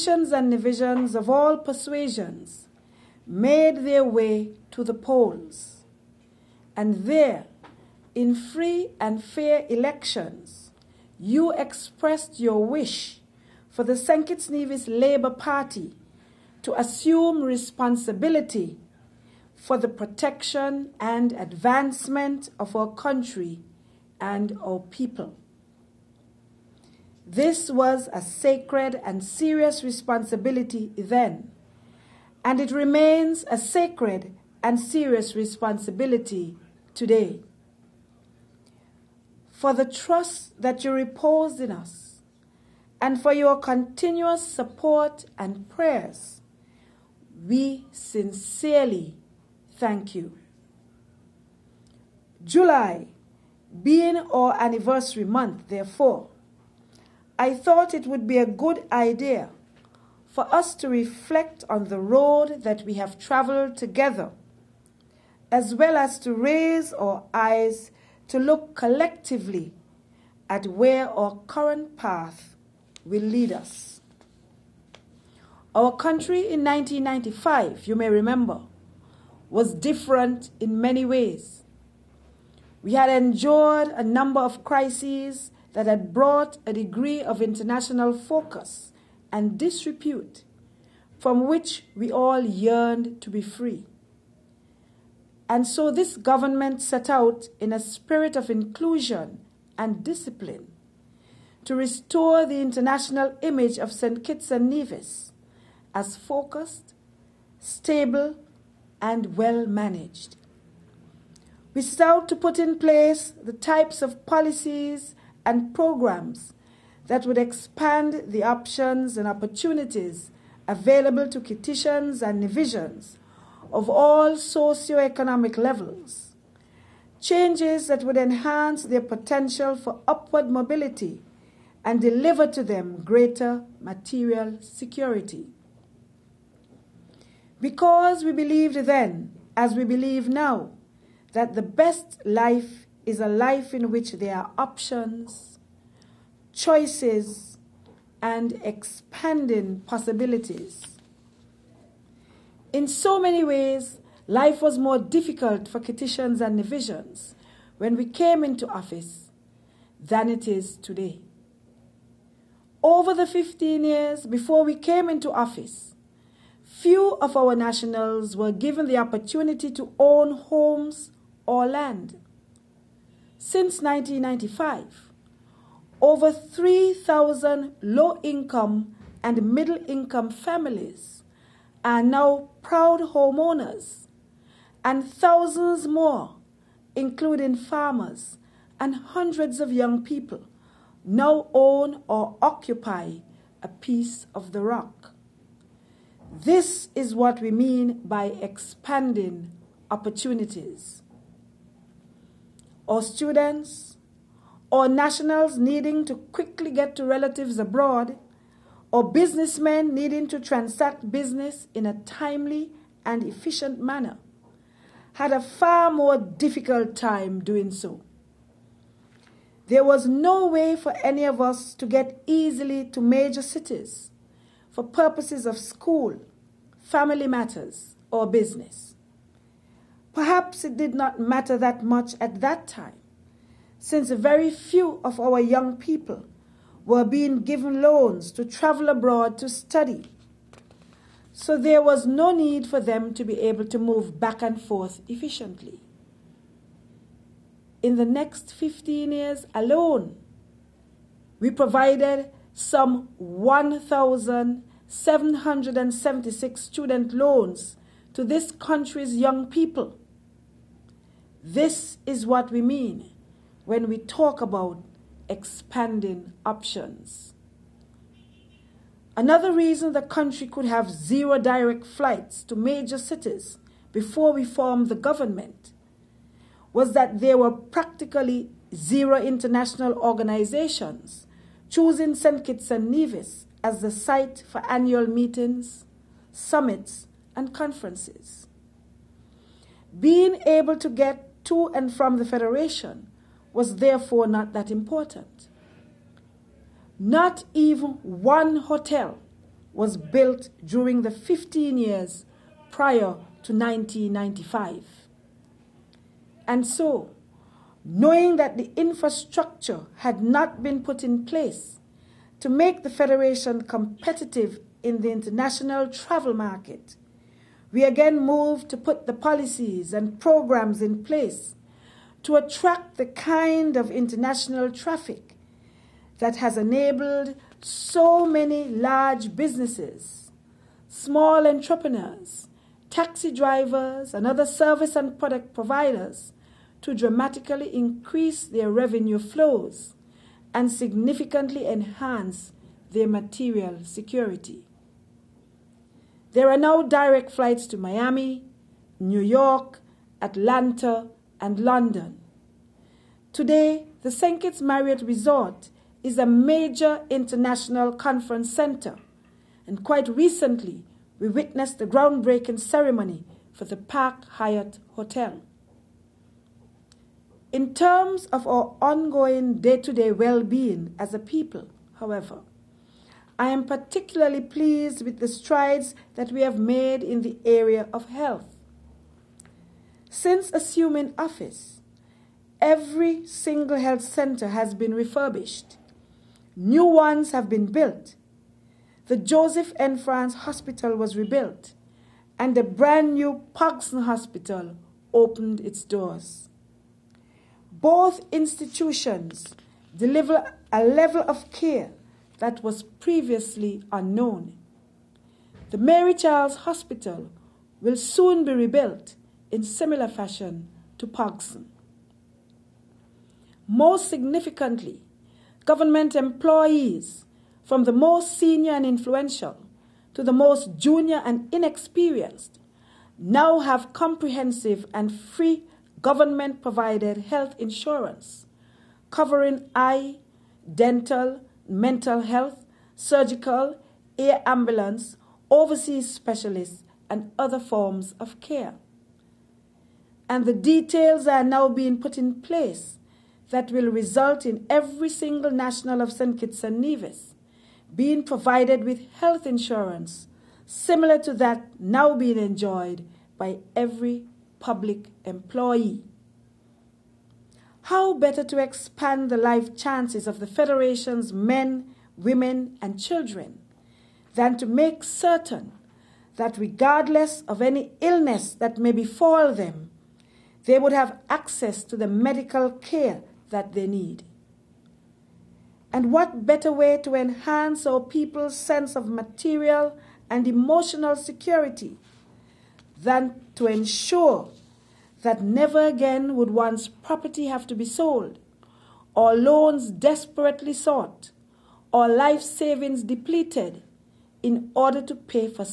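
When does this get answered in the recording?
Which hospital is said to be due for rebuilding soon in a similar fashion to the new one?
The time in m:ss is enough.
6:45.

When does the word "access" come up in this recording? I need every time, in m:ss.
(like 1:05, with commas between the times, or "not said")
7:51.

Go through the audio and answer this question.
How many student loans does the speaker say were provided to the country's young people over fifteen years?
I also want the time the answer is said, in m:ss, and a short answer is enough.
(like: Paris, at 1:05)
1,776, at 4:13.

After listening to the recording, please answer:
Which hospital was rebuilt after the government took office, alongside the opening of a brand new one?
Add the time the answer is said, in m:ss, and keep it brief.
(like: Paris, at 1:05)
Joseph N. France Hospital, at 6:29.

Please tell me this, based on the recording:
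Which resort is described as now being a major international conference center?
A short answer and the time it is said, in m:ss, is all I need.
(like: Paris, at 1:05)
St. Kitts Marriott Resort, at 5:54.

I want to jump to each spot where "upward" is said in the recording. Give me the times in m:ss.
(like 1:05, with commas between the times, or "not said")
2:10.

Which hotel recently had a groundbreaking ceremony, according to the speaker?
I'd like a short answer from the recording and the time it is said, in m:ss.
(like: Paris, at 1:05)
Park Hyatt, at 6:03.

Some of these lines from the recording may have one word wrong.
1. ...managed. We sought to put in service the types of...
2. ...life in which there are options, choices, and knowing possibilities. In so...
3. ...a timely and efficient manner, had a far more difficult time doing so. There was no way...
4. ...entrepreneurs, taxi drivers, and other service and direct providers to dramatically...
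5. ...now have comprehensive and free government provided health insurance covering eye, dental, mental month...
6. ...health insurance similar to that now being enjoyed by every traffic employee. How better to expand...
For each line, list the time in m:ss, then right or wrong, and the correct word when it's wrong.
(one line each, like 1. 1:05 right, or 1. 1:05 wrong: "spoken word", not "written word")
1. 1:49 wrong: "place", not "service"
2. 2:23 wrong: "expanding", not "knowing"
3. 3:31 right
4. 5:31 wrong: "product", not "direct"
5. 7:03 wrong: "health", not "month"
6. 7:29 wrong: "public", not "traffic".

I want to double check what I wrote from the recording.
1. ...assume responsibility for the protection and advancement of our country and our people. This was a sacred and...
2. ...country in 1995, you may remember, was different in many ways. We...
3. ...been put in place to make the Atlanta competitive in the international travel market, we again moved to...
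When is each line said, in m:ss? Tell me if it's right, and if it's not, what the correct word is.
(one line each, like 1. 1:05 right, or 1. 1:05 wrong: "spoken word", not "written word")
1. 0:16 right
2. 1:15 right
3. 5:10 wrong: "Federation", not "Atlanta".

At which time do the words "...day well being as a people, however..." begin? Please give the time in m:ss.
6:09.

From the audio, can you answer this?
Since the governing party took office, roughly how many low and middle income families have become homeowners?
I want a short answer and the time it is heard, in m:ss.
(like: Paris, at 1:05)
3,000, at 2:56.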